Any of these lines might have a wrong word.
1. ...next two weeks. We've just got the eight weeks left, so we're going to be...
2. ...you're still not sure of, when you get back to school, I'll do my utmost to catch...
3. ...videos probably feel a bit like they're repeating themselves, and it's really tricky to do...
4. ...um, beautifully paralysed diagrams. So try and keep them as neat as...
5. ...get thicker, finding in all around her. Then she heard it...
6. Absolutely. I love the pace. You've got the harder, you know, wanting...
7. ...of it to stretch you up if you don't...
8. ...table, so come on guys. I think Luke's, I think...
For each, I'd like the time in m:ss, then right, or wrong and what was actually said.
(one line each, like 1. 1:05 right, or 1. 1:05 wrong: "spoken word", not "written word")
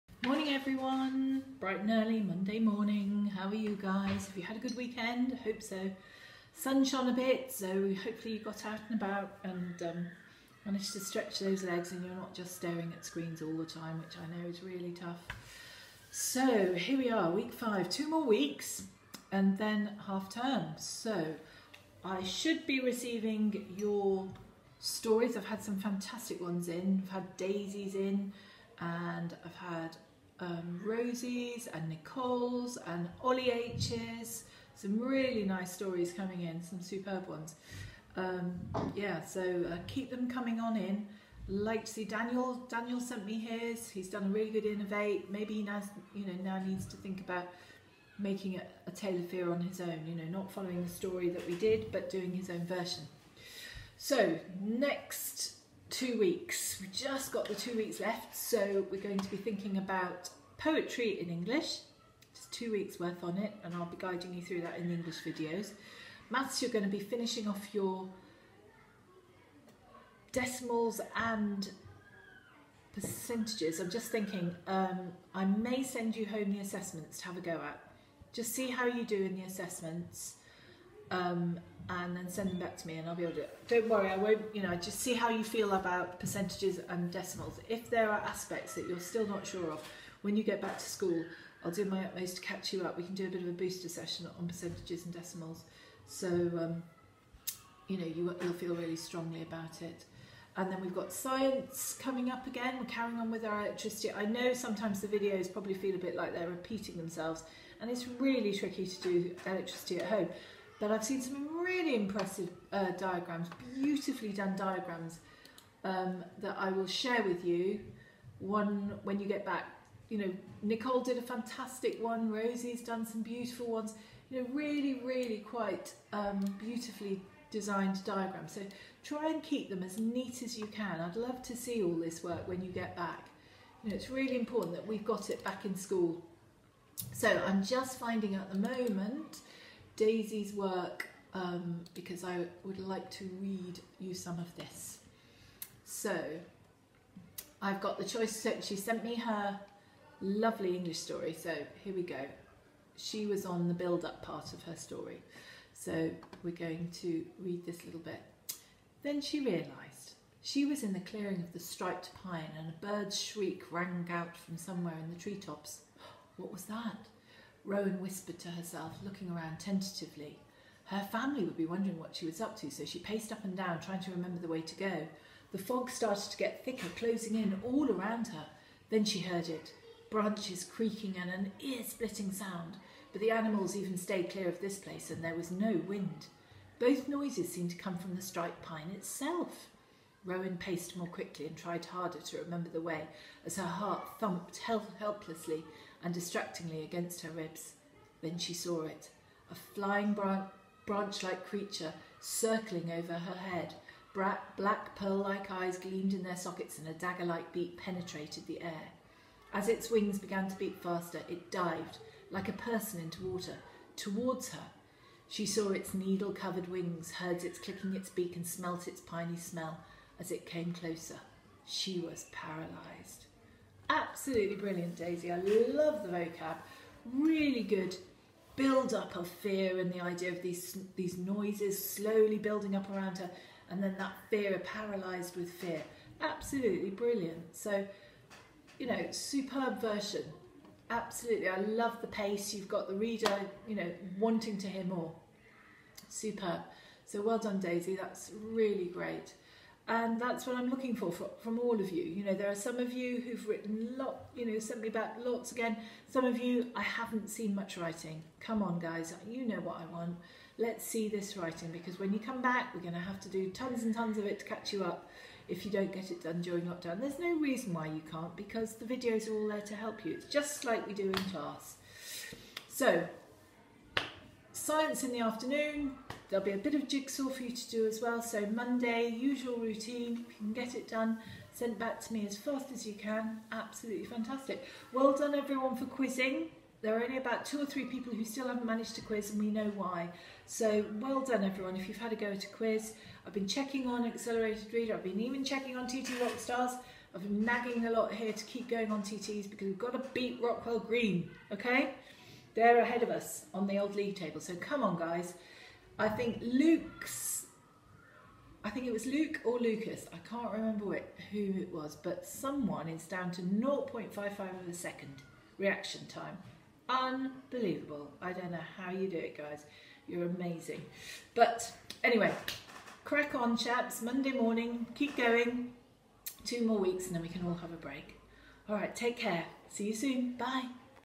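1. 0:54 wrong: "two", not "eight"
2. 1:28 right
3. 1:45 right
4. 2:06 wrong: "designed", not "paralysed"
5. 2:56 wrong: "closing", not "finding"
6. 4:00 wrong: "reader", not "harder"
7. 4:24 wrong: "catch", not "stretch"
8. 5:04 right.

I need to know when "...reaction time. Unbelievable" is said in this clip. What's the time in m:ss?
5:15.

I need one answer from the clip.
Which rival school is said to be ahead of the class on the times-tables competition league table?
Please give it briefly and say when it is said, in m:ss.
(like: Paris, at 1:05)
Rockwell Green, at 5:00.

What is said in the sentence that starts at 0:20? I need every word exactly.
So I should be receiving your stories.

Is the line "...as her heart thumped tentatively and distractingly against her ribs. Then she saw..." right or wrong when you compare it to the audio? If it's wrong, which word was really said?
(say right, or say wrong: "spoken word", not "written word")
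wrong: "helplessly", not "tentatively".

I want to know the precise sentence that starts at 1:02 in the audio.
Just two weeks worth on it, and I'll be guiding you through that in the English videos.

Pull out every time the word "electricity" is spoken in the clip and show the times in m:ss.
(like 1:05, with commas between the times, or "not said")
1:43, 1:49.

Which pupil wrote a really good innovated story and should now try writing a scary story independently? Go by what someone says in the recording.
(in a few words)
Daniel.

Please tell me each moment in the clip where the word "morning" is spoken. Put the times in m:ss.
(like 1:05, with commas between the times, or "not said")
0:02, 5:24.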